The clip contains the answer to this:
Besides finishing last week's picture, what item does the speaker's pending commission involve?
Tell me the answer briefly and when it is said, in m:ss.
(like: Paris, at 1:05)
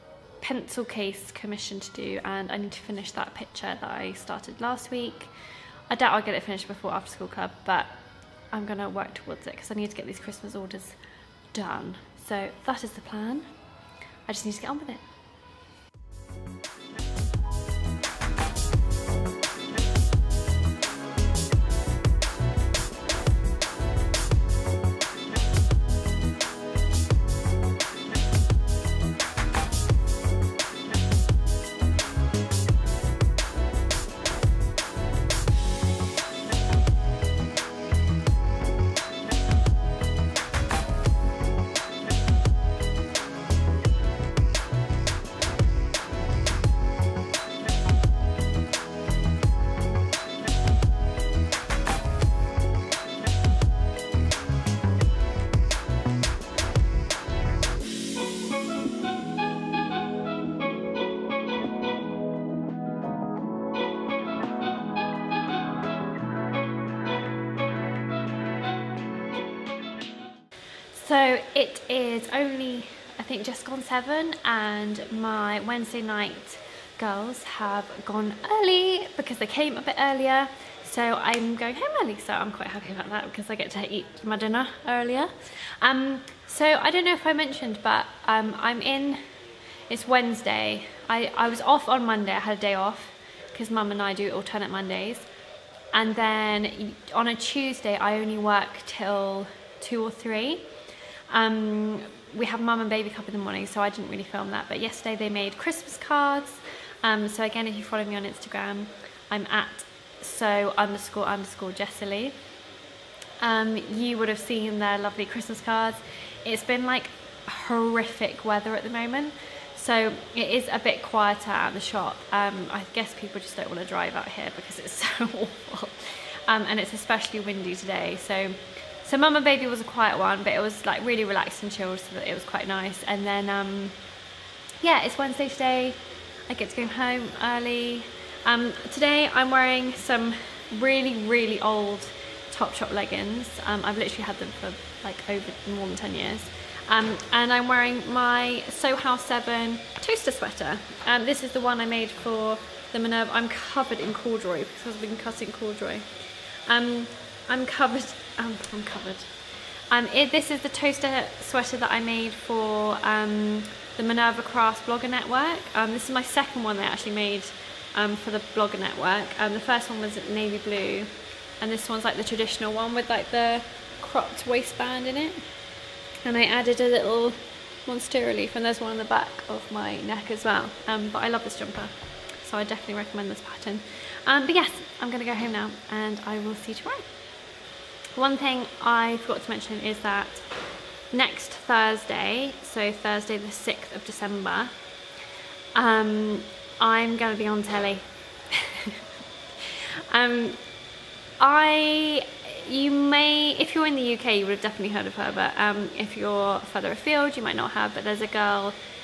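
pencil case, at 0:00.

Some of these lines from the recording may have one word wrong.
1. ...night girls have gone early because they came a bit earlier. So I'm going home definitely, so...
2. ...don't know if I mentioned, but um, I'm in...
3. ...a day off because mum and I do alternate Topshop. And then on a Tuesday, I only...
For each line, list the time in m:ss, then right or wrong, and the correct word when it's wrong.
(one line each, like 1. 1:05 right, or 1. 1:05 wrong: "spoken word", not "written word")
1. 1:16 wrong: "early", not "definitely"
2. 1:26 right
3. 1:32 wrong: "Mondays", not "Topshop".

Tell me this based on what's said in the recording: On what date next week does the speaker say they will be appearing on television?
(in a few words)
6th of December.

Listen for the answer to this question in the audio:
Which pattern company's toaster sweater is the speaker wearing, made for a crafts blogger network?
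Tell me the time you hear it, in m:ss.
2:28.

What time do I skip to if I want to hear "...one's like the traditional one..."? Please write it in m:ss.
2:51.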